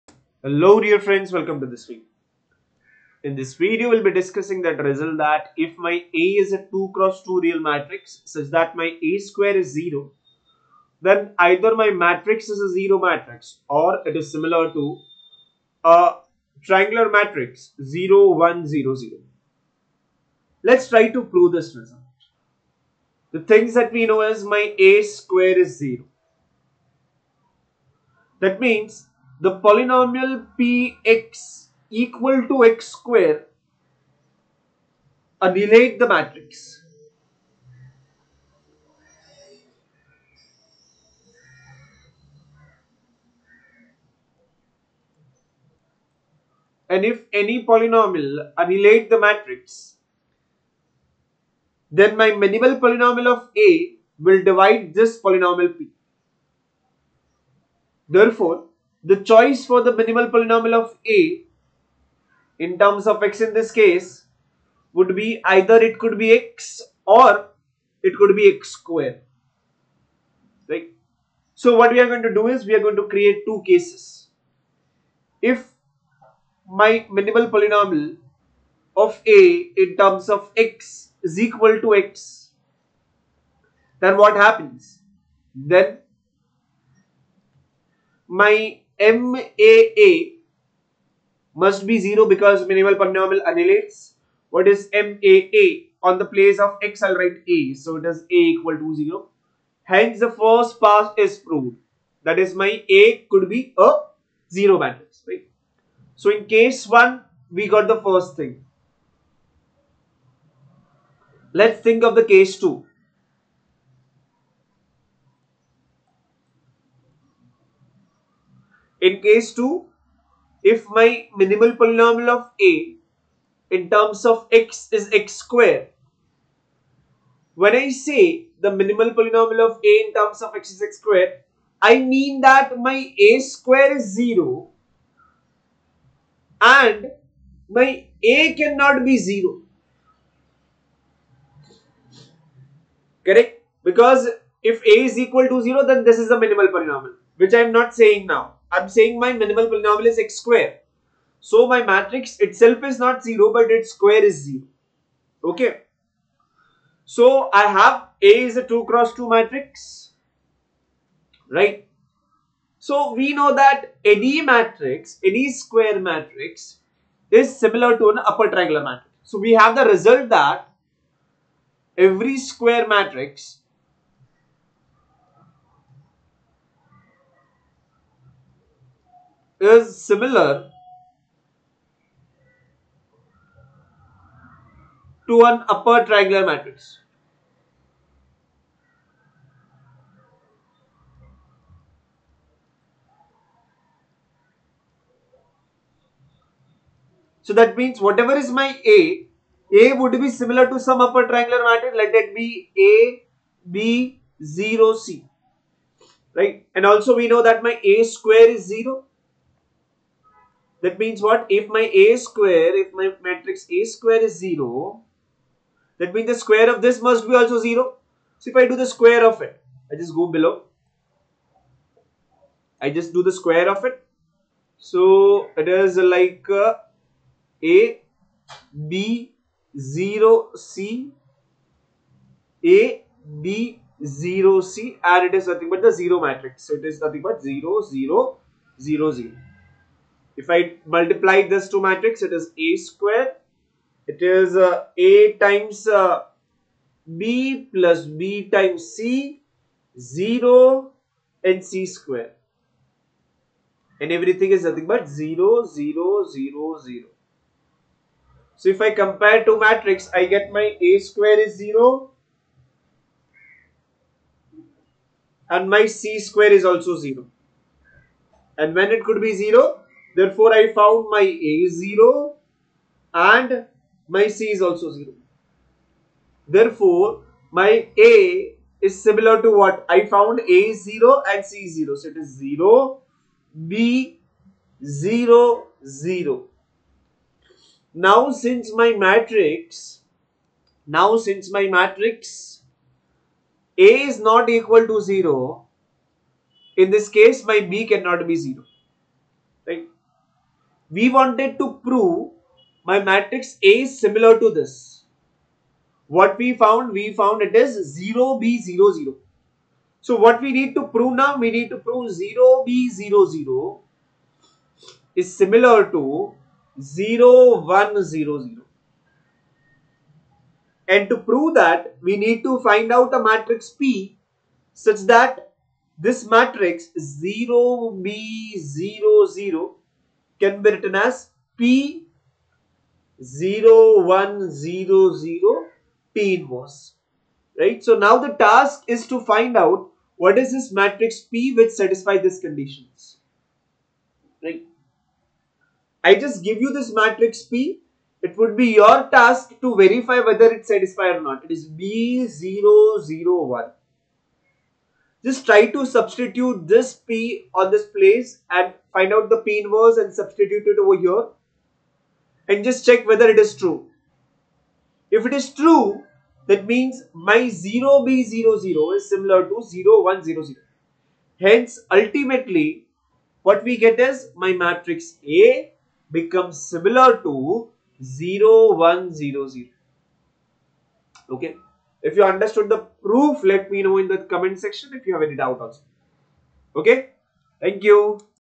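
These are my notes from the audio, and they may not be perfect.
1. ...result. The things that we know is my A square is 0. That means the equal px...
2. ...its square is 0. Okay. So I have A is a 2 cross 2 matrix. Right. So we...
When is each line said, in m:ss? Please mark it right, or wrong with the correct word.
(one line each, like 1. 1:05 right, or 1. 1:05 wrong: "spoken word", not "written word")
1. 0:21 wrong: "polynomial", not "equal"
2. 2:33 right.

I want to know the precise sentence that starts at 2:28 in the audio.
I'm saying my minimal polynomial is x square.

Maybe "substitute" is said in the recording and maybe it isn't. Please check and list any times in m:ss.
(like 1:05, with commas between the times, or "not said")
5:55, 6:00.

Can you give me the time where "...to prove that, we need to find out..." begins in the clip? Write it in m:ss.
5:21.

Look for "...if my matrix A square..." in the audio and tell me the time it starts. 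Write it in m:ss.
3:32.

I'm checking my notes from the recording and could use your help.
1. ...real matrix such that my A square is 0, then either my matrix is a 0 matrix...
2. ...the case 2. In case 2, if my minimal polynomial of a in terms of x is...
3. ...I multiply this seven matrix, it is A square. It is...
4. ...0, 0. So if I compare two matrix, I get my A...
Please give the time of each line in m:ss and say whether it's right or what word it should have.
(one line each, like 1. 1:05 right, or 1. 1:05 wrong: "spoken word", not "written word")
1. 0:07 right
2. 1:52 right
3. 4:00 wrong: "two", not "seven"
4. 4:16 right.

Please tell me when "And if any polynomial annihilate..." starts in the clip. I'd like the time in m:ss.
0:46.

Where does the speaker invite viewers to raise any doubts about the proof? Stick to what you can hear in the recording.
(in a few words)
Comment section.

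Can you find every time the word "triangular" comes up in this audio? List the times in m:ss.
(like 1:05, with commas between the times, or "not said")
0:16, 2:48, 3:06, 3:21.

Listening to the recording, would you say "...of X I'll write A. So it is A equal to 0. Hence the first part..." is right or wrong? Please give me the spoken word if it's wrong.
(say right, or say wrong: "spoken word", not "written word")
right.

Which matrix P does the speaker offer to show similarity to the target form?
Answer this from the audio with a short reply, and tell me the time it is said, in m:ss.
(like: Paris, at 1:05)
B, 0, 0, 1, at 5:51.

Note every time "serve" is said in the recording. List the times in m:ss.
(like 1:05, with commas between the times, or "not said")
not said.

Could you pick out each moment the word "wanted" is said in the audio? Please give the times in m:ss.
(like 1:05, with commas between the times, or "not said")
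5:01.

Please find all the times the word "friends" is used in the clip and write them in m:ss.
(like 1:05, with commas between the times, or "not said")
0:00.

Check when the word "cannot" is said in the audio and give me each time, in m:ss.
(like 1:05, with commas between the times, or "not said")
2:18, 4:57.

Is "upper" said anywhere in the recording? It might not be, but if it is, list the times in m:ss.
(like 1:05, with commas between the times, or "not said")
2:48, 3:05, 3:21.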